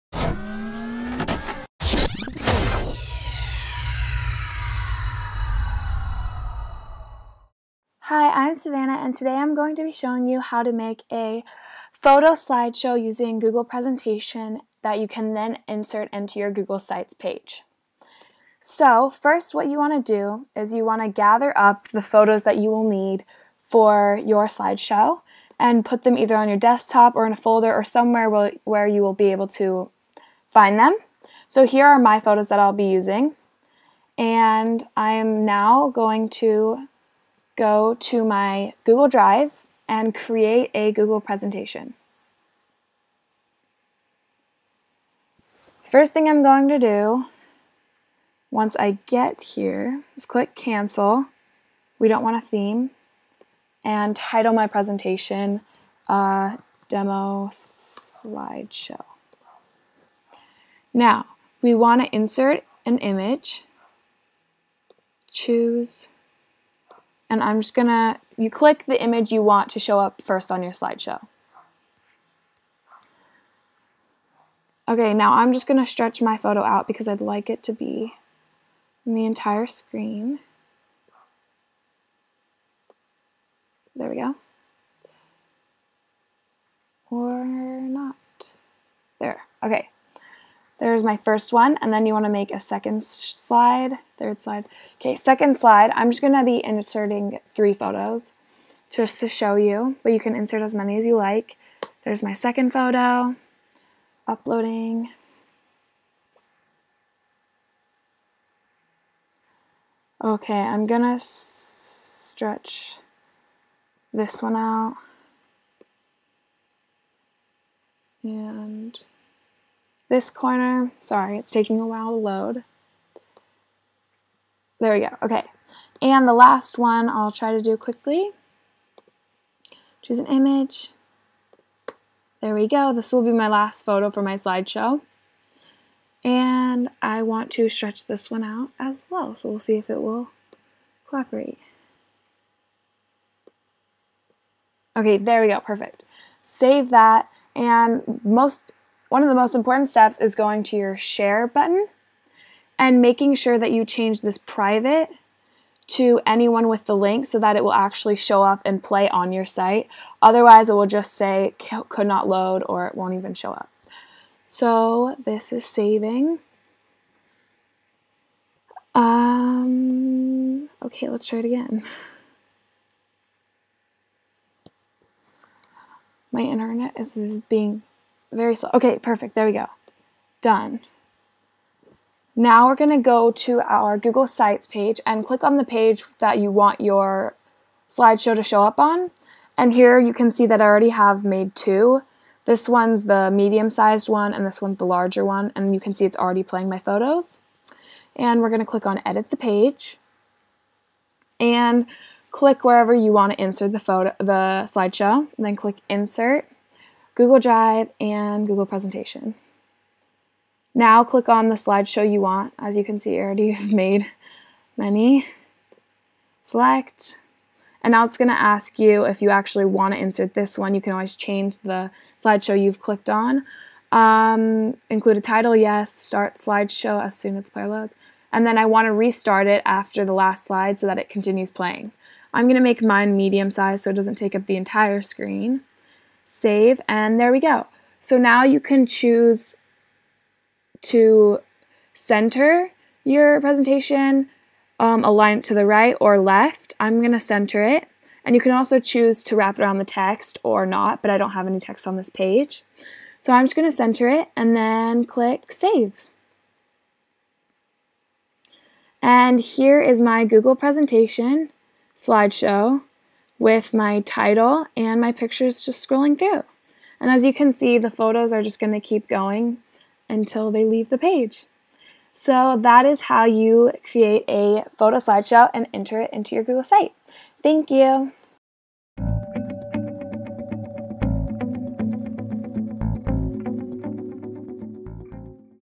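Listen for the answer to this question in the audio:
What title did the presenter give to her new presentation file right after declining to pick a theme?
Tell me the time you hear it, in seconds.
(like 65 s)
56 s.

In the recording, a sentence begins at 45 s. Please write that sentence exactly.
First thing I'm going to do once I get here is click cancel.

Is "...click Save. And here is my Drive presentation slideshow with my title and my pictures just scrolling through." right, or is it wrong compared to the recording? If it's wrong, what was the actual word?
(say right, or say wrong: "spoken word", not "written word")
wrong: "Google", not "Drive".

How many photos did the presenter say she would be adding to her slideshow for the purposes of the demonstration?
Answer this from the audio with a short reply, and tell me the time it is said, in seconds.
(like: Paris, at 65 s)
3, at 97 s.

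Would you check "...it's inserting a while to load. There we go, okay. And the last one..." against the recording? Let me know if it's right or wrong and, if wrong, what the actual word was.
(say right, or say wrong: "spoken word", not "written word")
wrong: "taking", not "inserting".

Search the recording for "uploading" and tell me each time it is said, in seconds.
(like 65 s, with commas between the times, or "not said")
104 s.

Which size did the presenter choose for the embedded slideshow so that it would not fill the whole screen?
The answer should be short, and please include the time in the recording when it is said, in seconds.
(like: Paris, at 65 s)
Medium, at 233 s.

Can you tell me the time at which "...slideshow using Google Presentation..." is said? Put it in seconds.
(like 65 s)
12 s.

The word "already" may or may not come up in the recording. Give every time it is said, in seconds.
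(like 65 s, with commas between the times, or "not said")
190 s, 196 s, 213 s.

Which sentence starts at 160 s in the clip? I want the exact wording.
Otherwise, it will just say could not load or it won't even show up.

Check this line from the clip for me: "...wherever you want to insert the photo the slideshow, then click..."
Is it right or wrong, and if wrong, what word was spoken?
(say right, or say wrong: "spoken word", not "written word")
right.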